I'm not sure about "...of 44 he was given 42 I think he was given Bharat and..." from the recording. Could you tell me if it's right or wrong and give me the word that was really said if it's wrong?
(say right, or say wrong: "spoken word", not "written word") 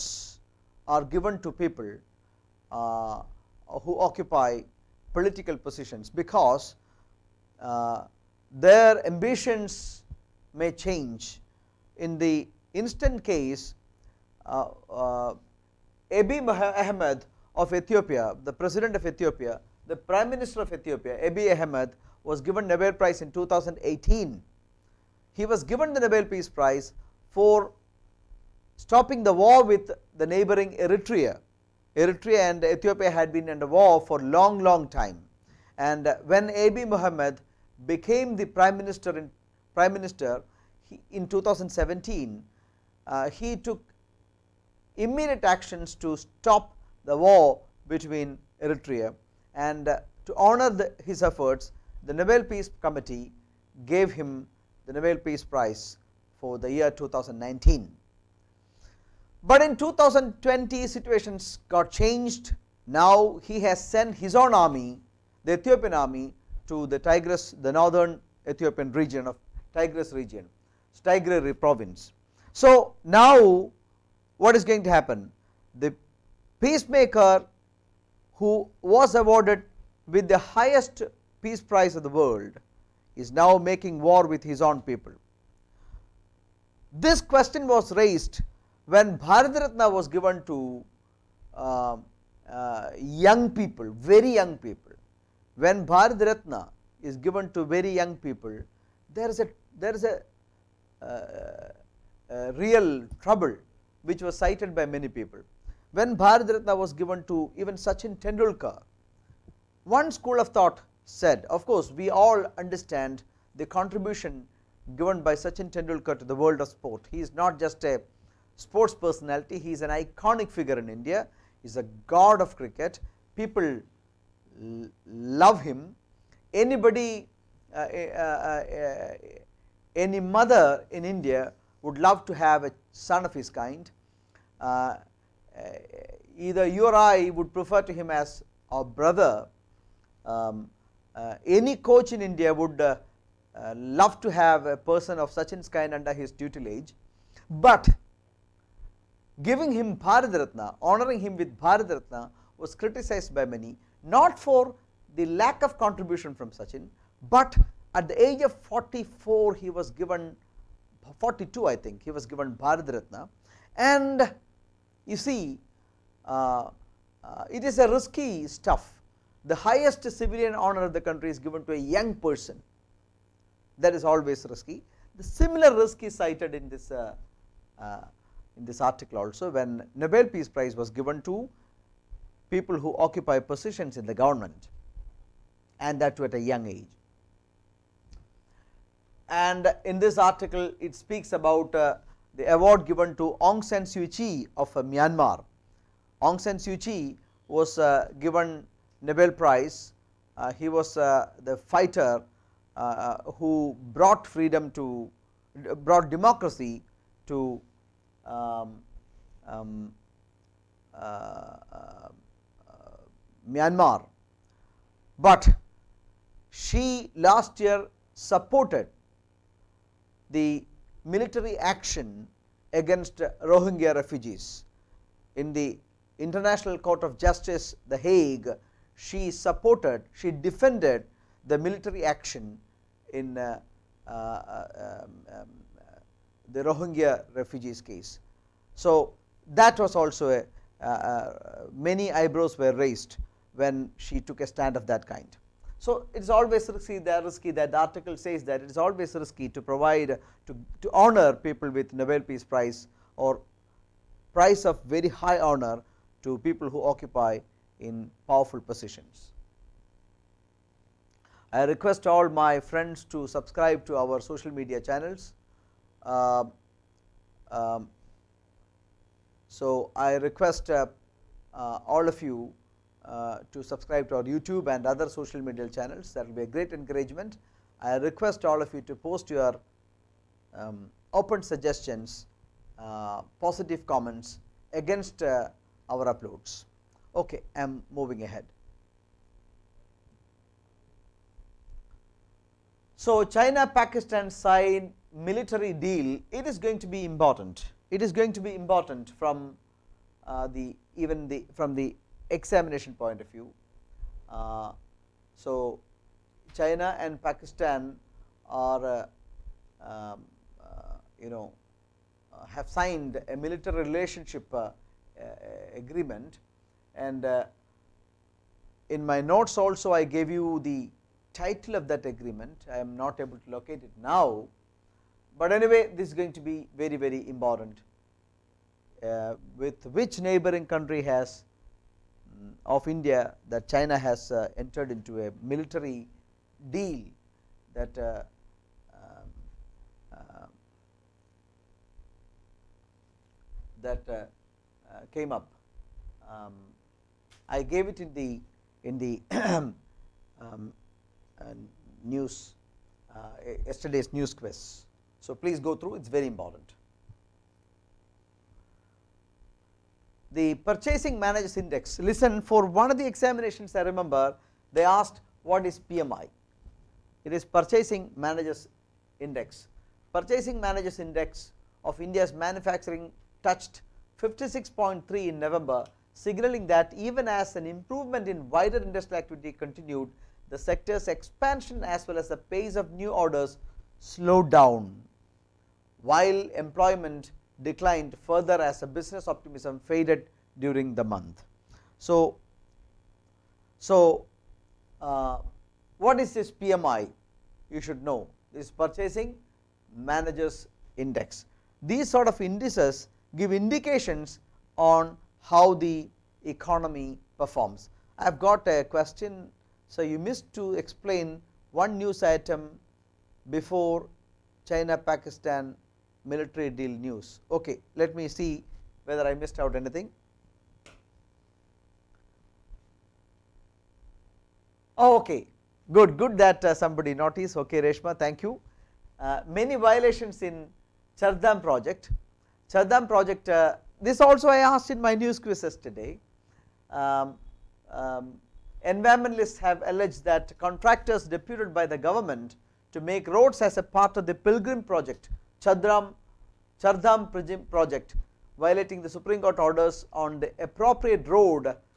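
right.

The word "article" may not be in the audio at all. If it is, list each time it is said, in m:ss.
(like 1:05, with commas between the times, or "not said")
2:58, 3:10, 4:07.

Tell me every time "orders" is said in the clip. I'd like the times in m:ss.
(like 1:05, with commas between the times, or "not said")
6:23, 7:29.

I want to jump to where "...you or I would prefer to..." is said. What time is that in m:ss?
2:16.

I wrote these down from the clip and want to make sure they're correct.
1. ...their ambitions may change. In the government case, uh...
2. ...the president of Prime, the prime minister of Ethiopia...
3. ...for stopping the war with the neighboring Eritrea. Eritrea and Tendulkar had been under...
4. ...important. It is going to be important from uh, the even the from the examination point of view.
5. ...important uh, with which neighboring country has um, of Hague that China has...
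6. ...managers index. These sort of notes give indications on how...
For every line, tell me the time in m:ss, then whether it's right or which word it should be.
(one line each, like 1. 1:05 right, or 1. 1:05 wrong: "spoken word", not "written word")
1. 0:08 wrong: "instant", not "government"
2. 0:18 wrong: "Ethiopia", not "Prime"
3. 0:27 wrong: "Ethiopia", not "Tendulkar"
4. 4:57 right
5. 5:27 wrong: "India", not "Hague"
6. 6:39 wrong: "indices", not "notes".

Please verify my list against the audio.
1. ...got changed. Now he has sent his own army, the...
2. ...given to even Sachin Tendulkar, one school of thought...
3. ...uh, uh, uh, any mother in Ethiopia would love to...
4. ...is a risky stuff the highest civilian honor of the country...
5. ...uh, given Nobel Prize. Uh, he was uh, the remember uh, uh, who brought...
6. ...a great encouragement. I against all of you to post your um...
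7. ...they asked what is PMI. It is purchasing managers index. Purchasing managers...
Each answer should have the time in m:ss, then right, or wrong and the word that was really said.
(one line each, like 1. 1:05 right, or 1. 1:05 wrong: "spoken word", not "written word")
1. 1:01 right
2. 1:46 right
3. 2:07 wrong: "India", not "Ethiopia"
4. 2:47 right
5. 3:17 wrong: "fighter", not "remember"
6. 4:36 wrong: "request", not "against"
7. 6:04 right.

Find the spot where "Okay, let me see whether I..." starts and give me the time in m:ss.
6:57.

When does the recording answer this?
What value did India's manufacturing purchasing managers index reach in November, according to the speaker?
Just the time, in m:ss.
6:14.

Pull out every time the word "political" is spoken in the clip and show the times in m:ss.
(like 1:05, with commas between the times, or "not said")
0:05.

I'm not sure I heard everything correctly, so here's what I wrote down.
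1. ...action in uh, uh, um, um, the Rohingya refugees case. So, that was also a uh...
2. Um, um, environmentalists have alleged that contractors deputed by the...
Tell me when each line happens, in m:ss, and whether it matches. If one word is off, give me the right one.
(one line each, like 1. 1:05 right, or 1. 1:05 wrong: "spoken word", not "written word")
1. 3:52 right
2. 7:16 right.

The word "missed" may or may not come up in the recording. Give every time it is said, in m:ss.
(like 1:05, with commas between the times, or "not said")
6:50, 6:59.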